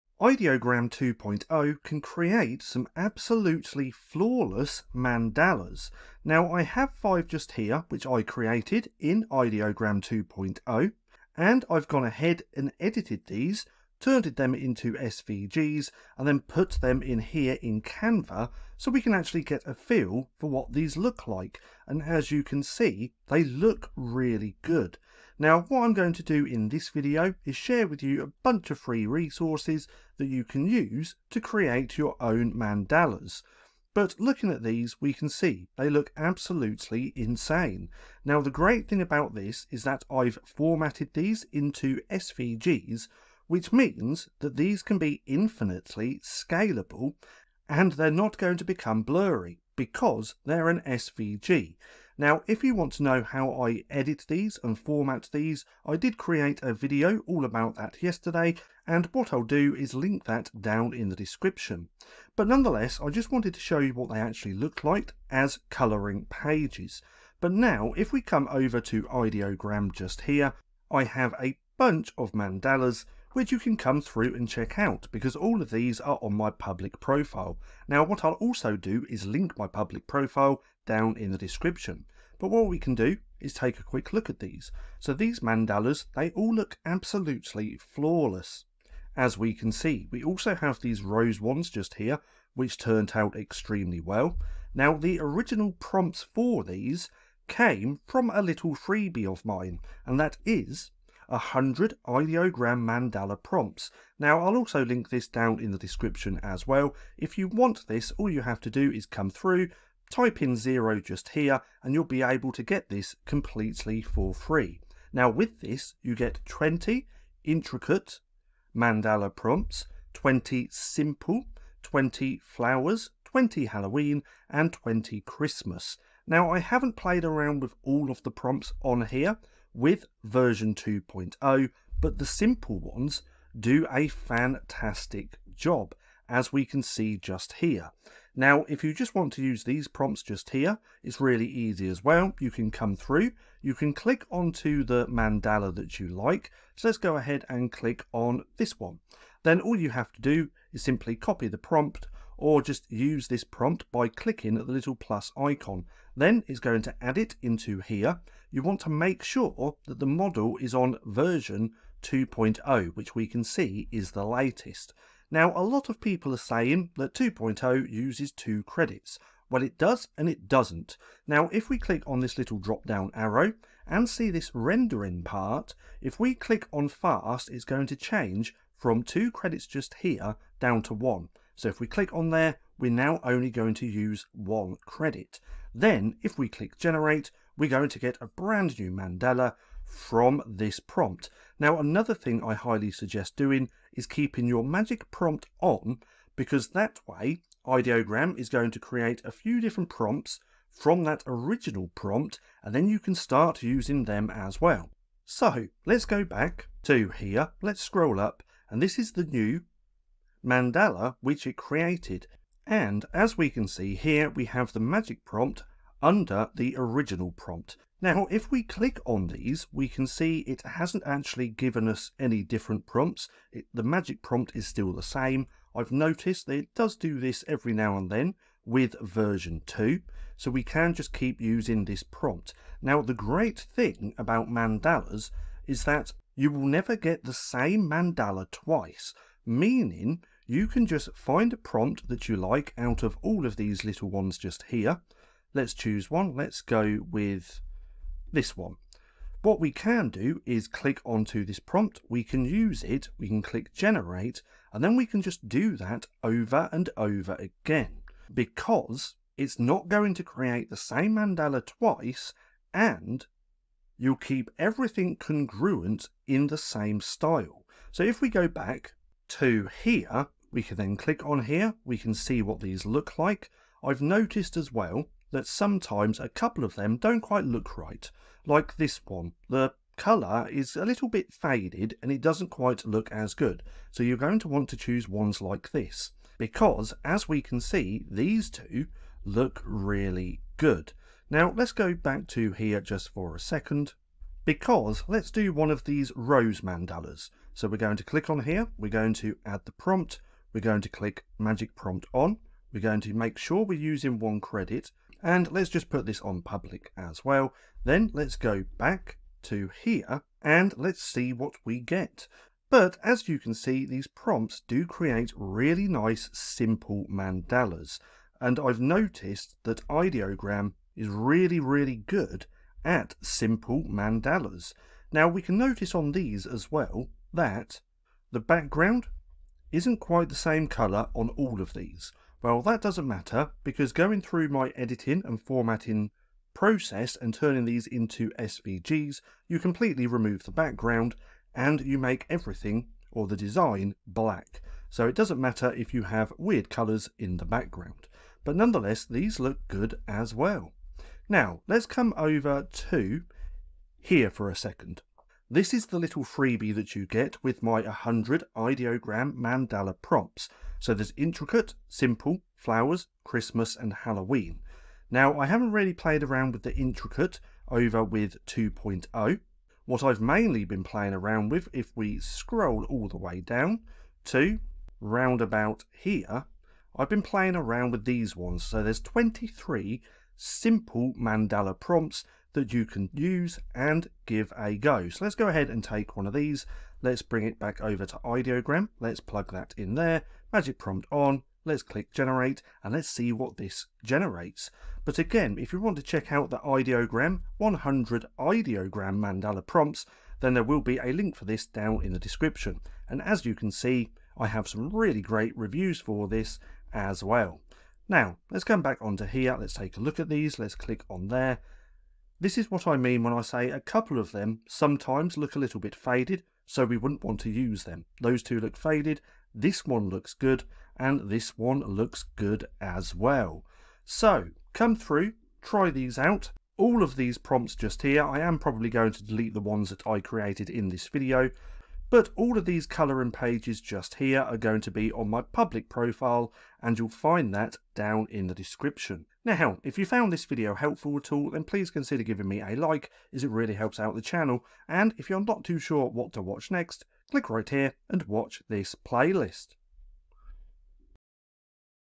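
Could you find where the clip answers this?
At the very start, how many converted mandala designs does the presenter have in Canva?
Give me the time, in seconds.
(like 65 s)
6 s.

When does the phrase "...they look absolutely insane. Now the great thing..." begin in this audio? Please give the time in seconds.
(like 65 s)
35 s.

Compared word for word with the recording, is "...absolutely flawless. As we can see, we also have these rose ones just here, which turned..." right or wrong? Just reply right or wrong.
right.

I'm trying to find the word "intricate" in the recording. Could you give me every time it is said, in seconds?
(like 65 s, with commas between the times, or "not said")
117 s, 361 s, 366 s.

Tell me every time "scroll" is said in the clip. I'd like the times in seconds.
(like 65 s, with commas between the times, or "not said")
207 s, 372 s.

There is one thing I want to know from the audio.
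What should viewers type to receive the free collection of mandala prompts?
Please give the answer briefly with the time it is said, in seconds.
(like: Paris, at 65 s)
0, at 110 s.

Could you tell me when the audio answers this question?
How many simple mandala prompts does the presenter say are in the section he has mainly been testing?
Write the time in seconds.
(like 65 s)
379 s.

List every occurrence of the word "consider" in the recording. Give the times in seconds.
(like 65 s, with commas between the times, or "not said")
441 s.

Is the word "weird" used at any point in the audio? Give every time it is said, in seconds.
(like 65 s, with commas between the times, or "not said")
346 s.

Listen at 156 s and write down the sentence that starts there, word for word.
Then it's going to add it into here.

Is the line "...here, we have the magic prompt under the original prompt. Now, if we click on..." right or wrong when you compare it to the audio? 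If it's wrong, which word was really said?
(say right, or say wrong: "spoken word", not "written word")
right.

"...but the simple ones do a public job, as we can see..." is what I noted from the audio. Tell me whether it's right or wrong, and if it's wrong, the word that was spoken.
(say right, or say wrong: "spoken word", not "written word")
wrong: "fantastic", not "public".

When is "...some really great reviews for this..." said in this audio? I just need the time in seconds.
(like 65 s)
404 s.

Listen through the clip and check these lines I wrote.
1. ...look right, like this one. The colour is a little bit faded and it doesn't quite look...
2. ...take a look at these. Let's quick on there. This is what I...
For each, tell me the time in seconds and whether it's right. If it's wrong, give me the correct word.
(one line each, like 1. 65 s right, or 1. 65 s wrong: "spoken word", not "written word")
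1. 277 s right
2. 409 s wrong: "click", not "quick".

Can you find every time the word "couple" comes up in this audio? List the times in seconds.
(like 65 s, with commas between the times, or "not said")
276 s, 413 s.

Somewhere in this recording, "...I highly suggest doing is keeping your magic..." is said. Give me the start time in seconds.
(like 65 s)
192 s.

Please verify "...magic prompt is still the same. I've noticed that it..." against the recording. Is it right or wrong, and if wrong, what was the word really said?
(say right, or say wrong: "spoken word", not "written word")
right.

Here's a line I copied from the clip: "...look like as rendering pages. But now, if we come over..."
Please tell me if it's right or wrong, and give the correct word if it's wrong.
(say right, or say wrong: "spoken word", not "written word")
wrong: "colouring", not "rendering".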